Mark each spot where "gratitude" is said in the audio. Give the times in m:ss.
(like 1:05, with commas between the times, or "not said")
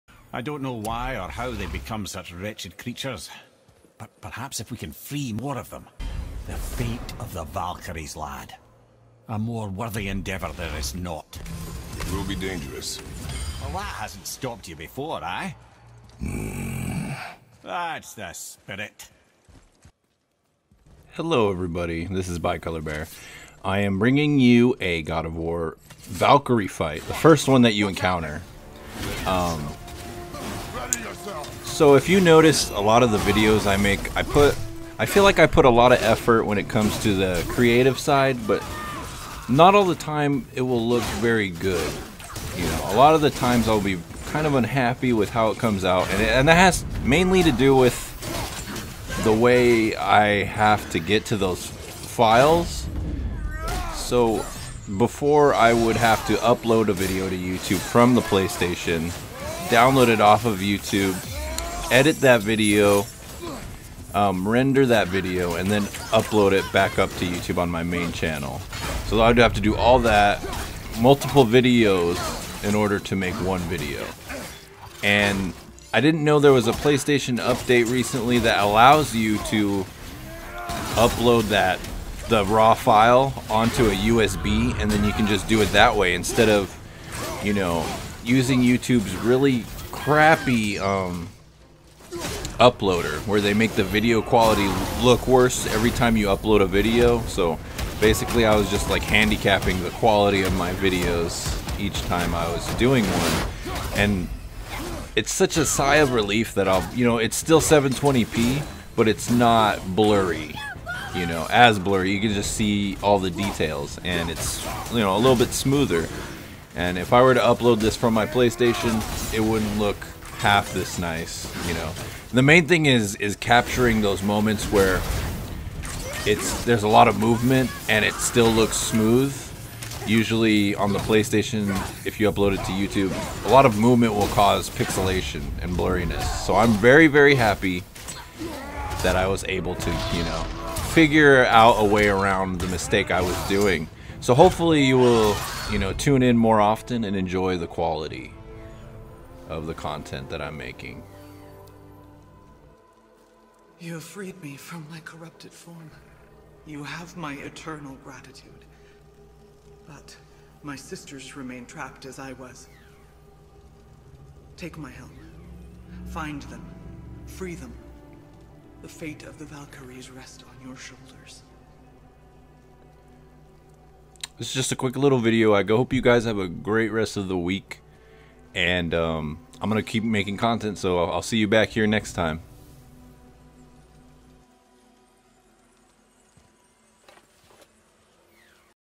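2:38.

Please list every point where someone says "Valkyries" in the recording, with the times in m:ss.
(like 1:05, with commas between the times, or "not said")
0:07, 0:25, 2:49.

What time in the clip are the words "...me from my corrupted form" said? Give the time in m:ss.
2:34.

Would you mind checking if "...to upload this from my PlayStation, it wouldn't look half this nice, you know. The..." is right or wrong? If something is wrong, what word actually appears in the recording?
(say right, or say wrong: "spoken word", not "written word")
right.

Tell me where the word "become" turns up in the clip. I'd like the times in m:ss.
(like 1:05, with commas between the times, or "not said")
0:01.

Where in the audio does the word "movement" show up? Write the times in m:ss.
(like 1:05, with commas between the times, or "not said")
2:07, 2:13.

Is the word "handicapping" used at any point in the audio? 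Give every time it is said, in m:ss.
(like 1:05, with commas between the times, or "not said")
1:39.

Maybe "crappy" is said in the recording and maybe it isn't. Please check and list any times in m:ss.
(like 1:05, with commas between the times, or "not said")
1:29.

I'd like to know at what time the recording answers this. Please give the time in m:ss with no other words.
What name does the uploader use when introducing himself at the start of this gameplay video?
0:22.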